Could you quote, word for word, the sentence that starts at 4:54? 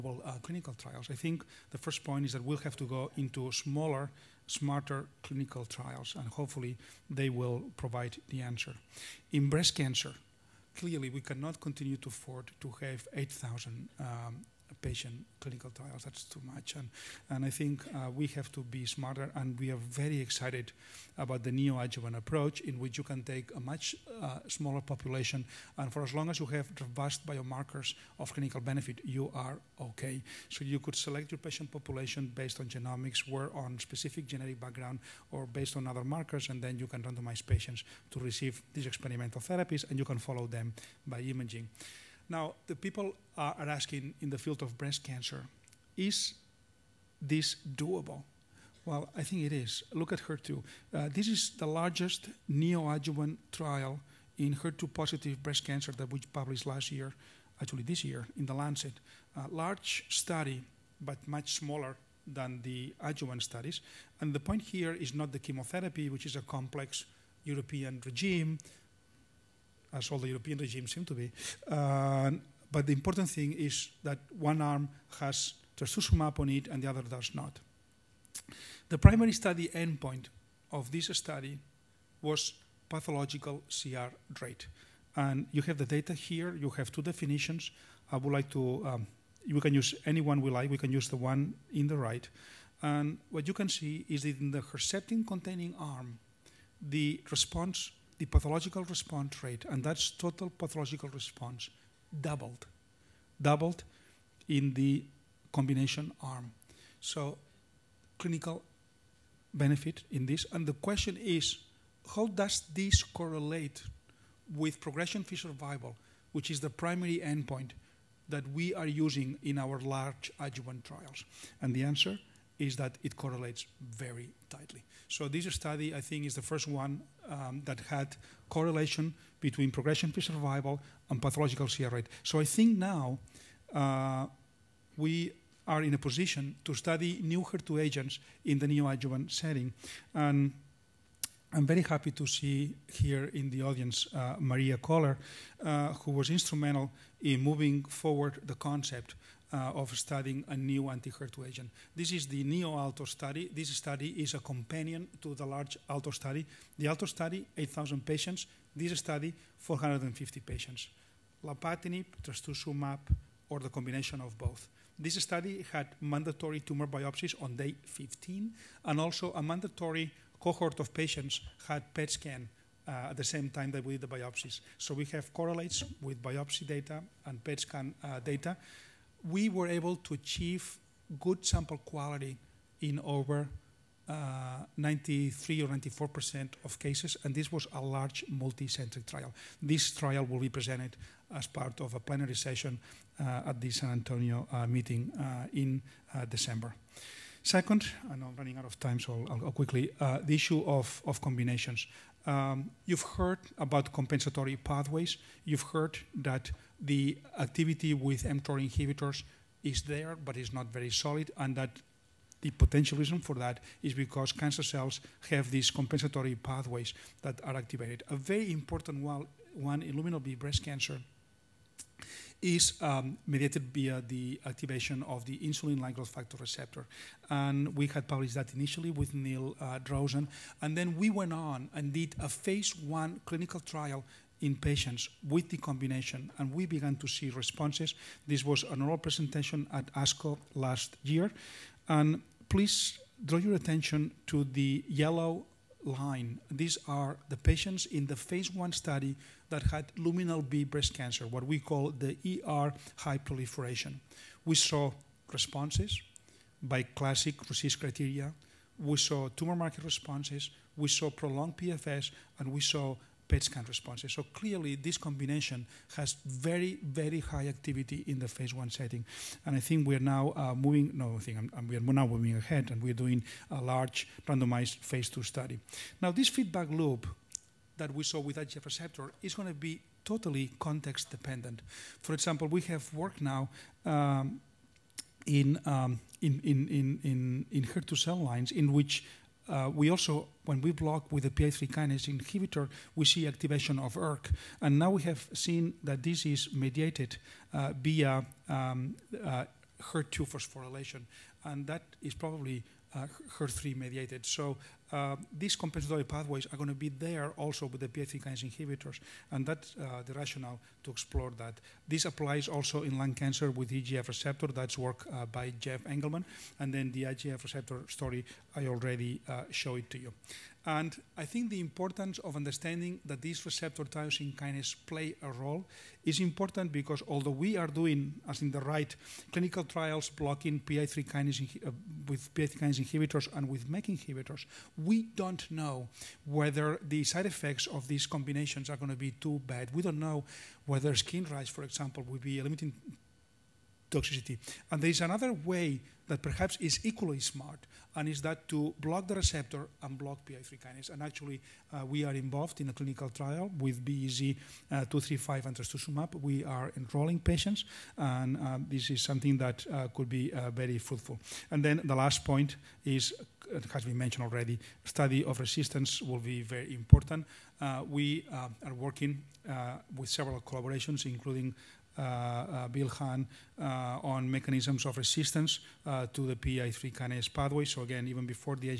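And now we have seen that this is mediated uh, via um, uh, HER2 phosphorylation.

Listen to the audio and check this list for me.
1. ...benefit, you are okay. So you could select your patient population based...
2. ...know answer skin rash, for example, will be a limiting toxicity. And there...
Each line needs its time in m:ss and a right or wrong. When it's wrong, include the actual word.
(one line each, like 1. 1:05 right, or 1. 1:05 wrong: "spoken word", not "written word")
1. 0:28 right
2. 5:39 wrong: "whether", not "answer".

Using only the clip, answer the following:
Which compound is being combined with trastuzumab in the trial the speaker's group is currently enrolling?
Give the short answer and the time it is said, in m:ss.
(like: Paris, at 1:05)
BEZ235, at 5:53.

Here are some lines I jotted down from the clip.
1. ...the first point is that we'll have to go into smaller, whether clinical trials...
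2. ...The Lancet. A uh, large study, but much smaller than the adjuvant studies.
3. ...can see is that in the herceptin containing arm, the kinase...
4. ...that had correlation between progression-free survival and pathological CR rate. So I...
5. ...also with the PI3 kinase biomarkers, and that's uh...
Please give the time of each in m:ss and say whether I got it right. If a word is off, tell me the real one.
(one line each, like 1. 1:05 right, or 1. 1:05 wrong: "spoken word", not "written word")
1. 0:01 wrong: "smarter", not "whether"
2. 0:58 right
3. 1:33 wrong: "response", not "kinase"
4. 2:07 right
5. 5:07 wrong: "inhibitors", not "biomarkers".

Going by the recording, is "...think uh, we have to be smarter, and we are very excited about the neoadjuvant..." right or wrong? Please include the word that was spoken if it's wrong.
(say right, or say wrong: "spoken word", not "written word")
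right.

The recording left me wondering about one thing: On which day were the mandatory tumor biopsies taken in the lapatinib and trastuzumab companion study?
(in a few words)
day 15.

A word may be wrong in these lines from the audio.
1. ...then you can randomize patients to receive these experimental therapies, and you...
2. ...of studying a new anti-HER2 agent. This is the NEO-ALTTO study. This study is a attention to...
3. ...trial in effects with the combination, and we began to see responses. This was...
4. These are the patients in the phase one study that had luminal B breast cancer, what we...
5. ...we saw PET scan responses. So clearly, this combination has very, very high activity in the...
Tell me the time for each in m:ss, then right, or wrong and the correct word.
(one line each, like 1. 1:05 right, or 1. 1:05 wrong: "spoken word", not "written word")
1. 0:36 right
2. 2:29 wrong: "companion", not "attention"
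3. 3:53 wrong: "patients", not "effects"
4. 4:06 right
5. 4:22 right.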